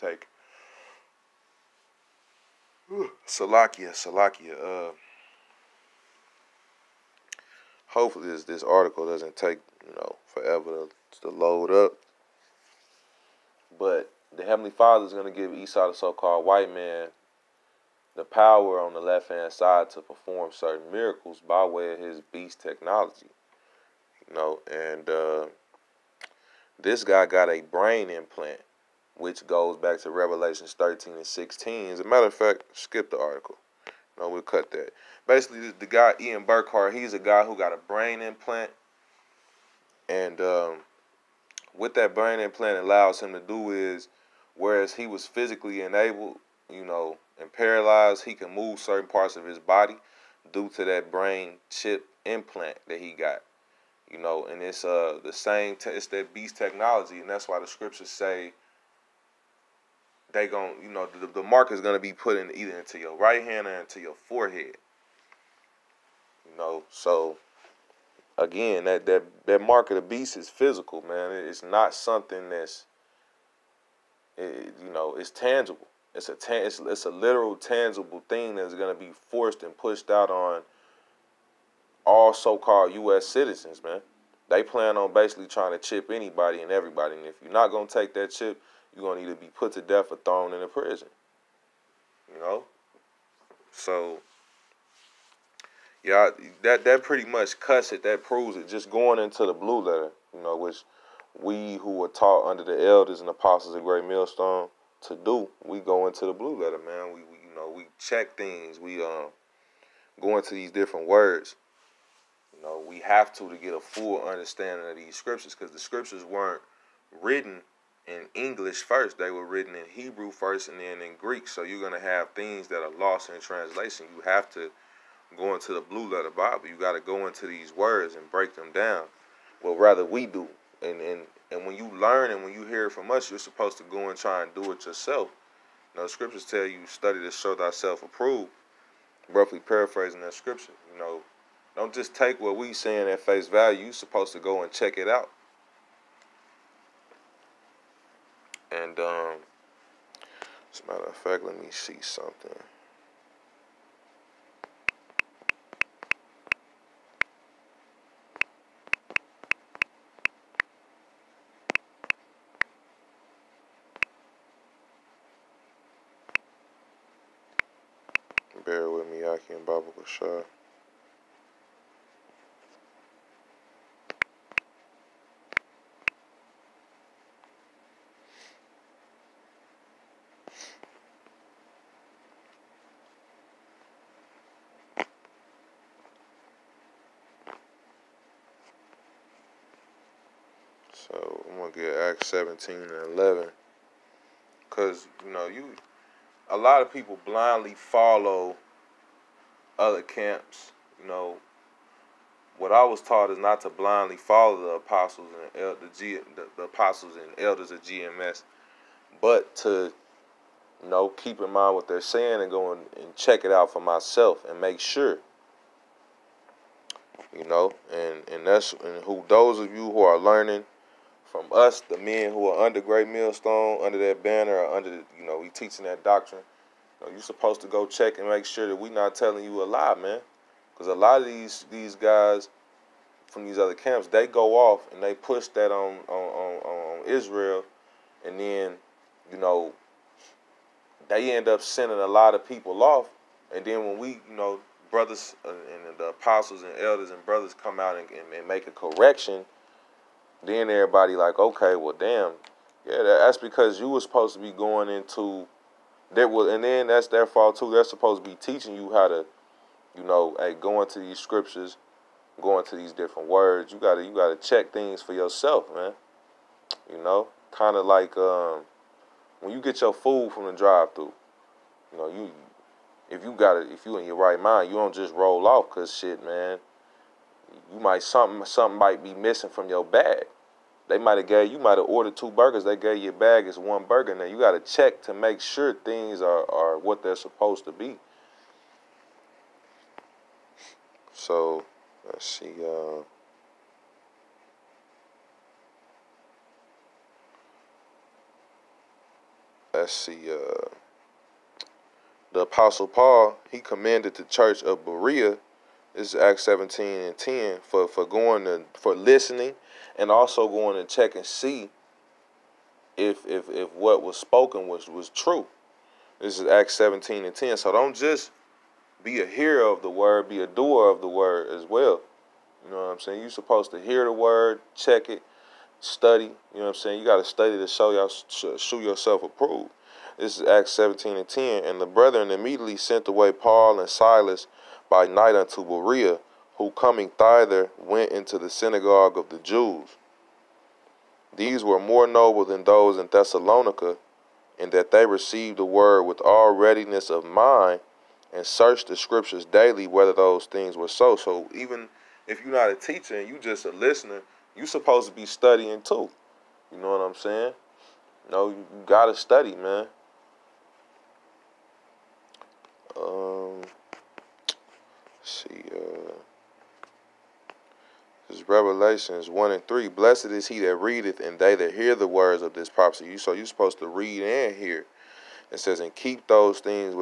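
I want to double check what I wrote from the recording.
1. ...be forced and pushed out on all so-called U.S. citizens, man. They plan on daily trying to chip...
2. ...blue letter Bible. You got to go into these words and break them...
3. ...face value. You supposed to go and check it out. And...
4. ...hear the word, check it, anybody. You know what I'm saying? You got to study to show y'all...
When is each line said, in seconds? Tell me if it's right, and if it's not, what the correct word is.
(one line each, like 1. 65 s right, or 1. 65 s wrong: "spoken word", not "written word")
1. 78 s wrong: "basically", not "daily"
2. 125 s right
3. 143 s right
4. 323 s wrong: "study", not "anybody".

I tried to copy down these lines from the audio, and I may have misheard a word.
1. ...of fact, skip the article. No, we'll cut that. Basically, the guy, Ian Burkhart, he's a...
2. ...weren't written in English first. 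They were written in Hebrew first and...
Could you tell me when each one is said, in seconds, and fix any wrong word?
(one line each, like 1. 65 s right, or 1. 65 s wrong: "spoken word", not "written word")
1. 32 s right
2. 116 s right.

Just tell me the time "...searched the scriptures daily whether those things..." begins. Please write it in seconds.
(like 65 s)
348 s.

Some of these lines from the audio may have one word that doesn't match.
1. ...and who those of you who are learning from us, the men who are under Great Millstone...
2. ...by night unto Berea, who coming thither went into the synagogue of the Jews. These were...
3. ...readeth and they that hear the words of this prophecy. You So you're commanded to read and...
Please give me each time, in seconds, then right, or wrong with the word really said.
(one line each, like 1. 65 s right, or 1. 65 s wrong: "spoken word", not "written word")
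1. 218 s right
2. 334 s right
3. 370 s wrong: "supposed", not "commanded".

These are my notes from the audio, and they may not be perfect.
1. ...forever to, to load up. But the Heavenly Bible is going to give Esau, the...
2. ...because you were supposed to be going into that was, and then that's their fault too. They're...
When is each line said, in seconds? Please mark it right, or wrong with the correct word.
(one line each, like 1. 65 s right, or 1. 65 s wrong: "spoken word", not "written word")
1. 10 s wrong: "Father", not "Bible"
2. 253 s right.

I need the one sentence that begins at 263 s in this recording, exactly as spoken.
You gotta, you gotta check things for yourself, man.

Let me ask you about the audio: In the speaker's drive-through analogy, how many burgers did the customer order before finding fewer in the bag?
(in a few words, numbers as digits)
2.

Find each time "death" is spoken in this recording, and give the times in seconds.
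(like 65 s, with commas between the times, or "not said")
89 s.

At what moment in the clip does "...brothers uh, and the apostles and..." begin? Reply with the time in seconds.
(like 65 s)
244 s.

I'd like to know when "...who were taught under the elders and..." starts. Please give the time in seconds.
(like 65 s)
101 s.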